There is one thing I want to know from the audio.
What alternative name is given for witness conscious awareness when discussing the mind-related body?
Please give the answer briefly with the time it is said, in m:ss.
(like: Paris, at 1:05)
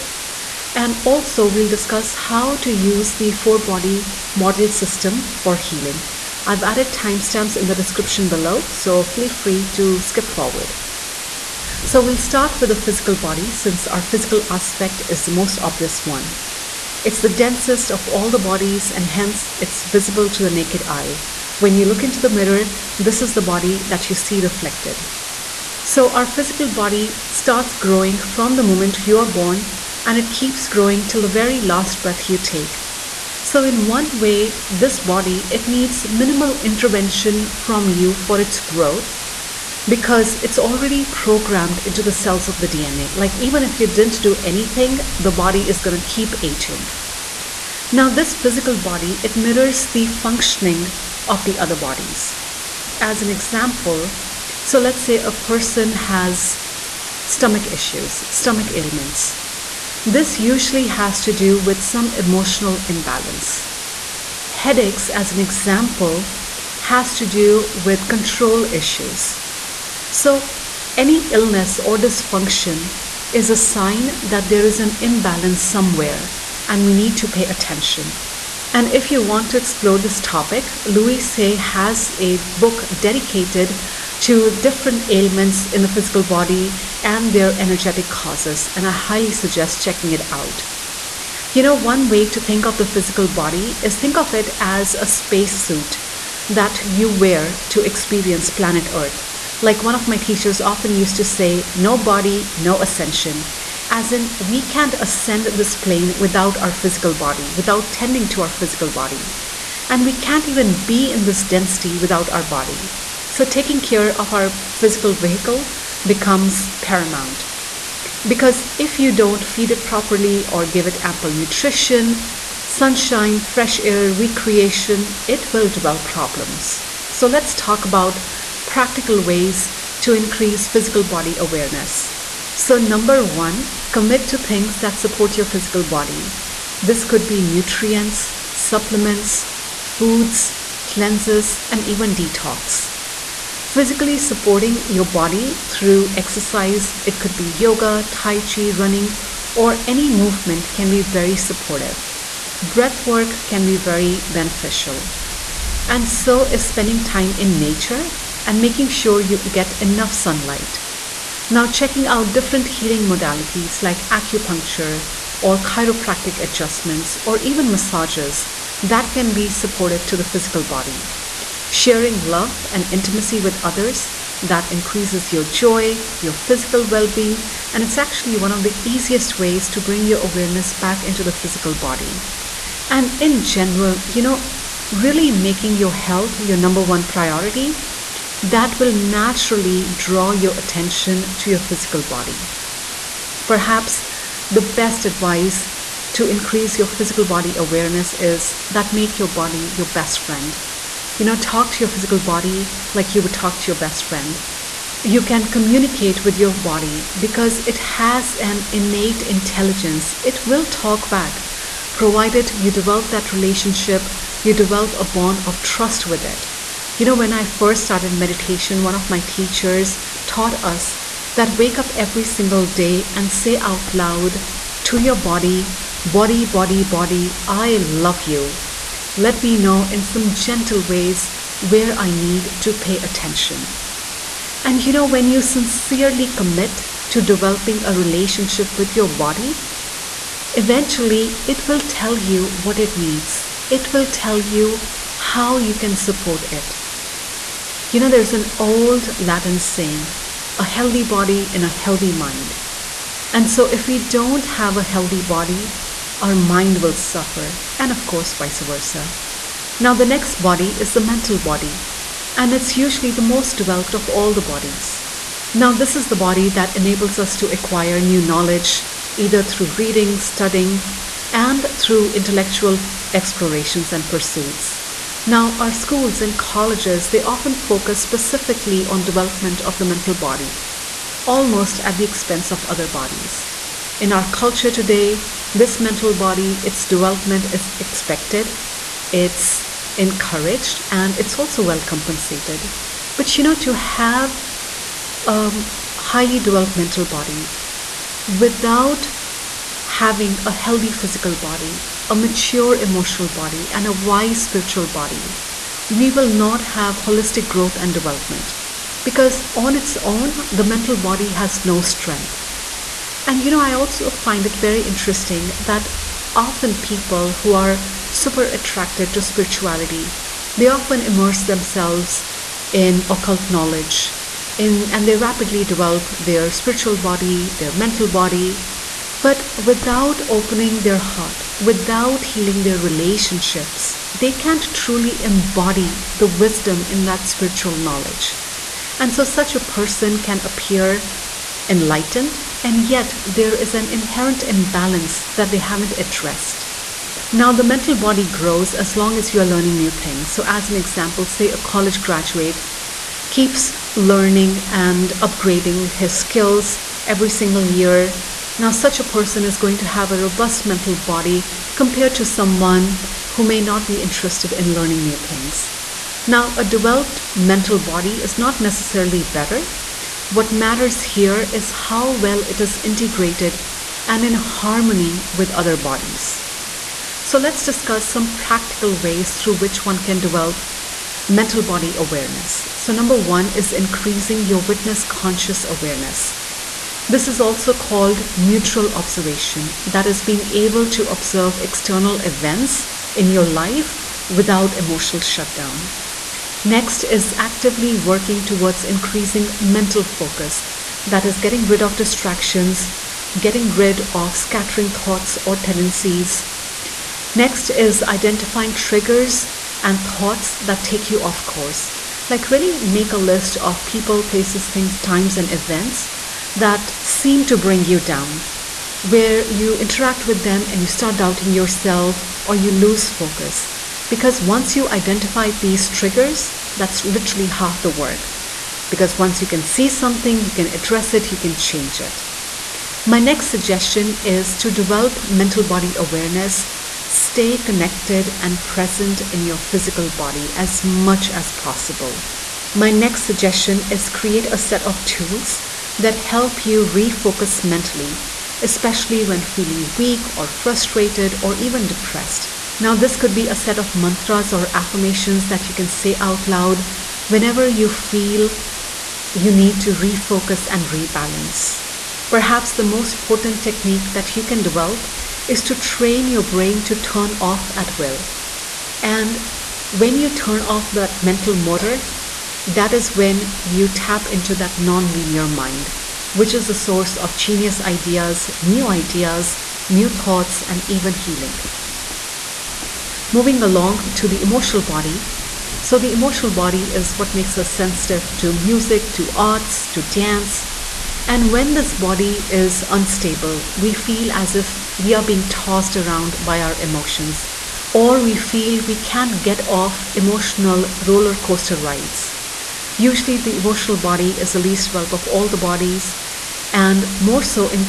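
Neutral observation, at 6:28.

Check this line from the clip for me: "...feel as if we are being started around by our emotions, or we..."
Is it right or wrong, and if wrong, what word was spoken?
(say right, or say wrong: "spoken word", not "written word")
wrong: "tossed", not "started".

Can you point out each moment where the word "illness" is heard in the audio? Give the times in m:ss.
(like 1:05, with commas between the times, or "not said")
1:11.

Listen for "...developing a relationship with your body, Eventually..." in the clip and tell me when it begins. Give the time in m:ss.
3:57.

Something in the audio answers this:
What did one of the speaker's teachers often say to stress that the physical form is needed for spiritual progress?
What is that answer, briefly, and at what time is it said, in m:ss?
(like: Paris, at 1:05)
No body, no ascension, at 1:41.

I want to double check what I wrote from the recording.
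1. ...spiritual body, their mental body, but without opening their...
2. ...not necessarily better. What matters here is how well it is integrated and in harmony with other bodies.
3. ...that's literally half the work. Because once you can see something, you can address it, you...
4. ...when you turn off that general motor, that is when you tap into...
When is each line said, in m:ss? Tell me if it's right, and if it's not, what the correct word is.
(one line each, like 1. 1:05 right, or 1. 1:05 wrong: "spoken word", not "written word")
1. 5:26 right
2. 6:08 right
3. 7:06 right
4. 7:49 wrong: "mental", not "general".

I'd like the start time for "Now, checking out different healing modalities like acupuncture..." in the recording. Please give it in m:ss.
2:41.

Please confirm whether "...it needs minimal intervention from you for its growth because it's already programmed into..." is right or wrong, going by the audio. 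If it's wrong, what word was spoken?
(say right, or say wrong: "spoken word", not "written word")
right.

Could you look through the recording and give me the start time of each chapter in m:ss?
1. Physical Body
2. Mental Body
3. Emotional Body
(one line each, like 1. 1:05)
1. 0:08
2. 4:14
3. 8:02.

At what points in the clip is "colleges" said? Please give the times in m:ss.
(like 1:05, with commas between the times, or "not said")
4:36, 5:51.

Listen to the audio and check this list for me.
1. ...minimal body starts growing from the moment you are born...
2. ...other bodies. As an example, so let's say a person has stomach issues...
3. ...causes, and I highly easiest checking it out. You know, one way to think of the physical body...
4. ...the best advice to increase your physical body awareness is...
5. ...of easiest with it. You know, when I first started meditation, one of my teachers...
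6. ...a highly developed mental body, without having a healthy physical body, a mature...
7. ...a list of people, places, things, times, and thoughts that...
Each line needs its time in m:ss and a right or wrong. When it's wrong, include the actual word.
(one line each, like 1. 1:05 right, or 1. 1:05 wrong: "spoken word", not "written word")
1. 0:26 wrong: "physical", not "minimal"
2. 0:51 right
3. 1:28 wrong: "suggest", not "easiest"
4. 3:14 right
5. 3:35 wrong: "trust", not "easiest"
6. 4:55 right
7. 6:53 wrong: "events", not "thoughts".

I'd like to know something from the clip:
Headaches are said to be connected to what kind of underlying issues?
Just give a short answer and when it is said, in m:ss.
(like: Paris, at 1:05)
Control issues, at 1:08.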